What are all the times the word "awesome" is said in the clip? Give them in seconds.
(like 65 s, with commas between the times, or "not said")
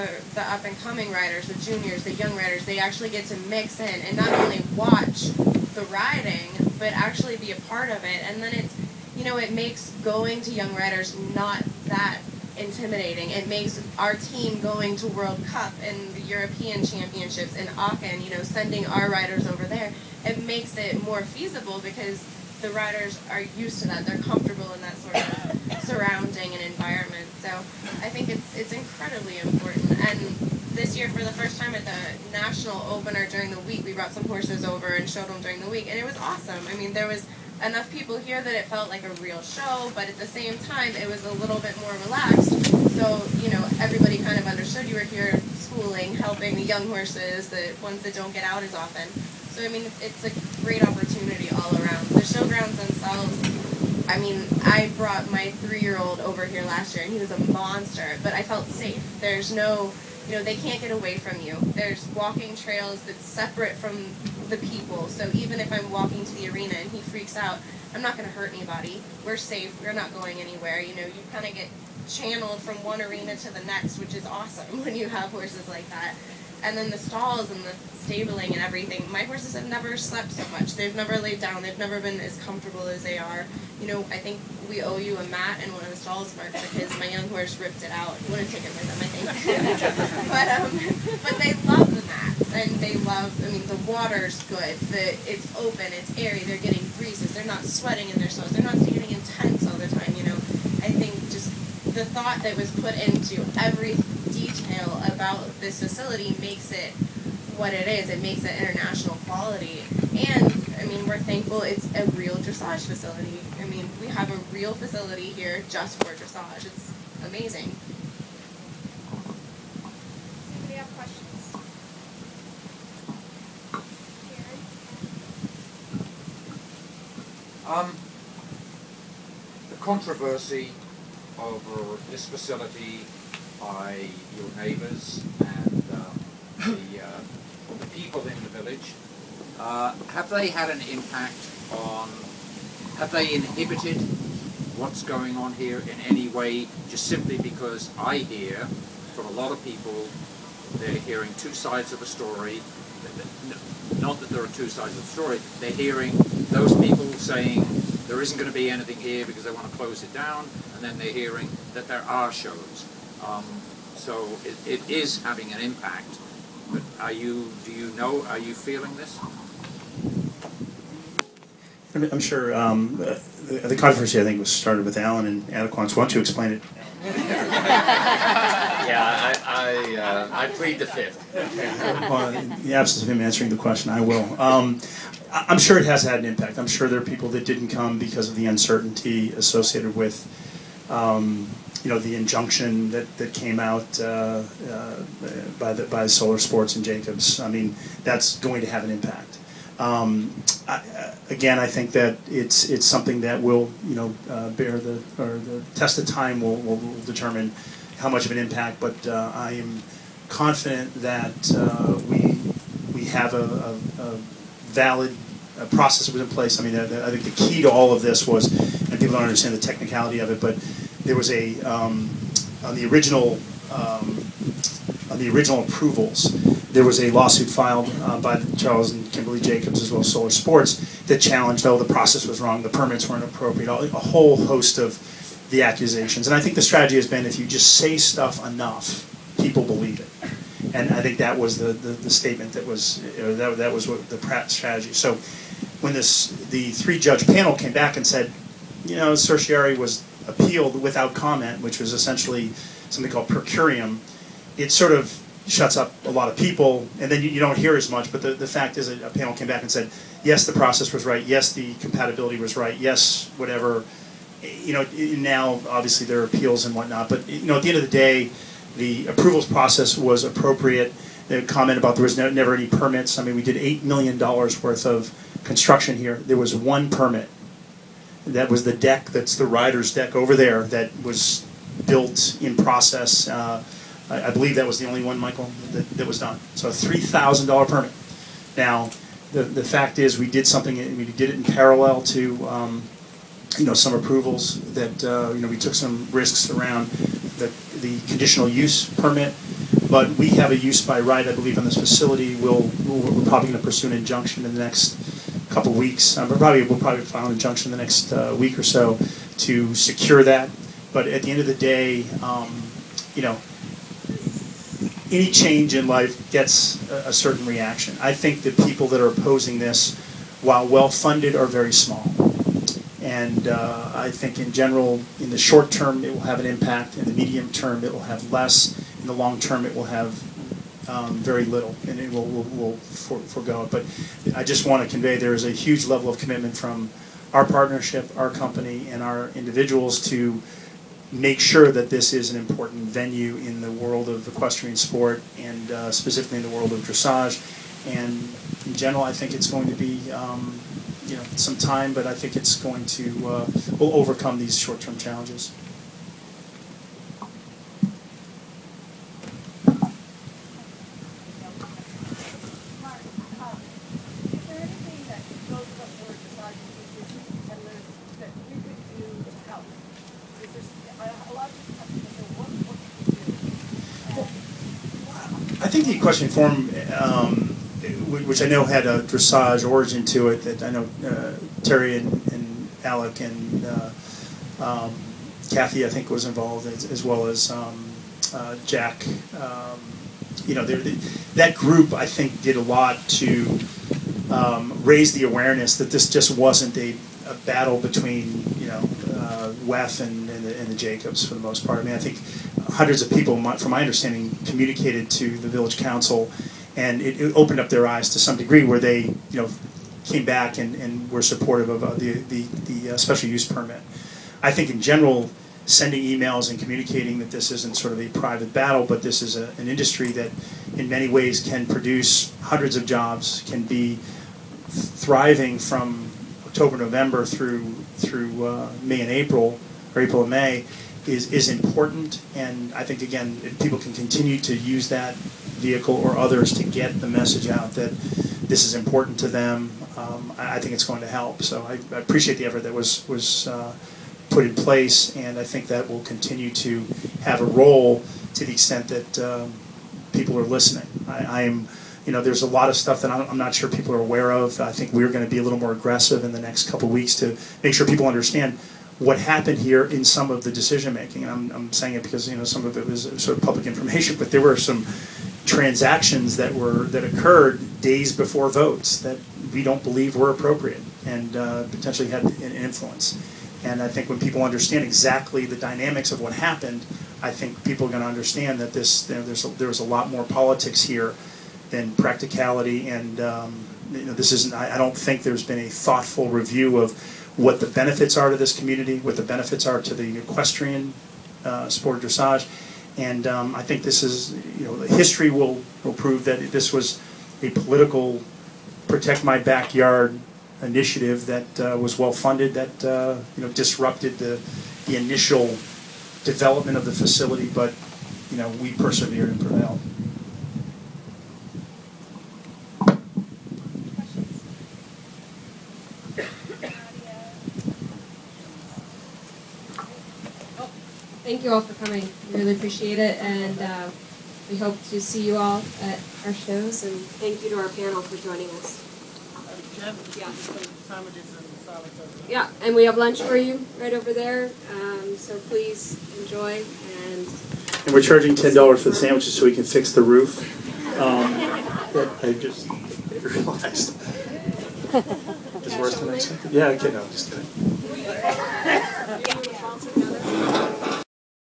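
36 s, 74 s.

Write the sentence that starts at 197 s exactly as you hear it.
I mean, that's going to have an impact.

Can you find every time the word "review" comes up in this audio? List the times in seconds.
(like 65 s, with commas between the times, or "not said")
486 s.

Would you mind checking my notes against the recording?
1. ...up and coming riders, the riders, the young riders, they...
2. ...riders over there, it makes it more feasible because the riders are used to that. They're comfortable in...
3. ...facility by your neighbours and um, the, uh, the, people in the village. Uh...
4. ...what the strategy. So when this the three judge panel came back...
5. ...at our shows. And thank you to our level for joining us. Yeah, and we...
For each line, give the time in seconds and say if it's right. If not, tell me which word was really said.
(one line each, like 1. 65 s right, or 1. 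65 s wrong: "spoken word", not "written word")
1. 0 s wrong: "juniors", not "riders"
2. 19 s right
3. 132 s right
4. 243 s right
5. 525 s wrong: "panel", not "level".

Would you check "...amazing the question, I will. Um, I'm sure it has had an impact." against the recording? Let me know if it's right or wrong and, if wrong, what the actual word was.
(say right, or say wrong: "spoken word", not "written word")
wrong: "answering", not "amazing".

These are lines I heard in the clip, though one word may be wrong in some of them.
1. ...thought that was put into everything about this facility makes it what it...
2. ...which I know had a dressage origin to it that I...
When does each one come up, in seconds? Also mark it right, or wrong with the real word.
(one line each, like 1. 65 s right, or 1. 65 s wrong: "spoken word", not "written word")
1. 102 s right
2. 378 s right.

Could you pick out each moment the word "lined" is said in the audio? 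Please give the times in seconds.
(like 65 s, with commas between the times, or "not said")
not said.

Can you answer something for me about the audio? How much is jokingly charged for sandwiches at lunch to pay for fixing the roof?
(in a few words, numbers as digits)
$10.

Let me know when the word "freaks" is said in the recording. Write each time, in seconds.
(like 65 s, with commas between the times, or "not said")
66 s.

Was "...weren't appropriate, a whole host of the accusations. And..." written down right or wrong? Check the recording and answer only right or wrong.
right.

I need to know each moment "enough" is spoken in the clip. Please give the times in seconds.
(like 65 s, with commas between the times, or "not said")
37 s, 238 s.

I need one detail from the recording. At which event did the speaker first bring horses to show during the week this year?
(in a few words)
national opener.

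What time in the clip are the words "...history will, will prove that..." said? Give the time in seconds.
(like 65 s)
494 s.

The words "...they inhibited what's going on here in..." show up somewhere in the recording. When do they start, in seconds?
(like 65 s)
143 s.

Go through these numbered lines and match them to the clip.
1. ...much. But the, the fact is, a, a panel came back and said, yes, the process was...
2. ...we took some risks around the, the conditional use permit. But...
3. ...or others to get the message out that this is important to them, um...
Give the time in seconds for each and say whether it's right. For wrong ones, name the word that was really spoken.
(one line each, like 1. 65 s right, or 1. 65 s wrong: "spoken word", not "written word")
1. 257 s right
2. 295 s right
3. 435 s right.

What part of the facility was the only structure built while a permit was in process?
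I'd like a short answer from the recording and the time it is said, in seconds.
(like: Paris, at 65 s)
the rider's deck, at 279 s.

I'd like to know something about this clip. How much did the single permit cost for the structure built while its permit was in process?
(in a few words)
$3,000.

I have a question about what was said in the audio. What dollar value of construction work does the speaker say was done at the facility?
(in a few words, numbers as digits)
$8 million.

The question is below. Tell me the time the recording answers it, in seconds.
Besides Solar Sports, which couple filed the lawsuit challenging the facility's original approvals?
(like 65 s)
228 s.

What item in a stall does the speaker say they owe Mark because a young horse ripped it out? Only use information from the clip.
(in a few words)
a mat.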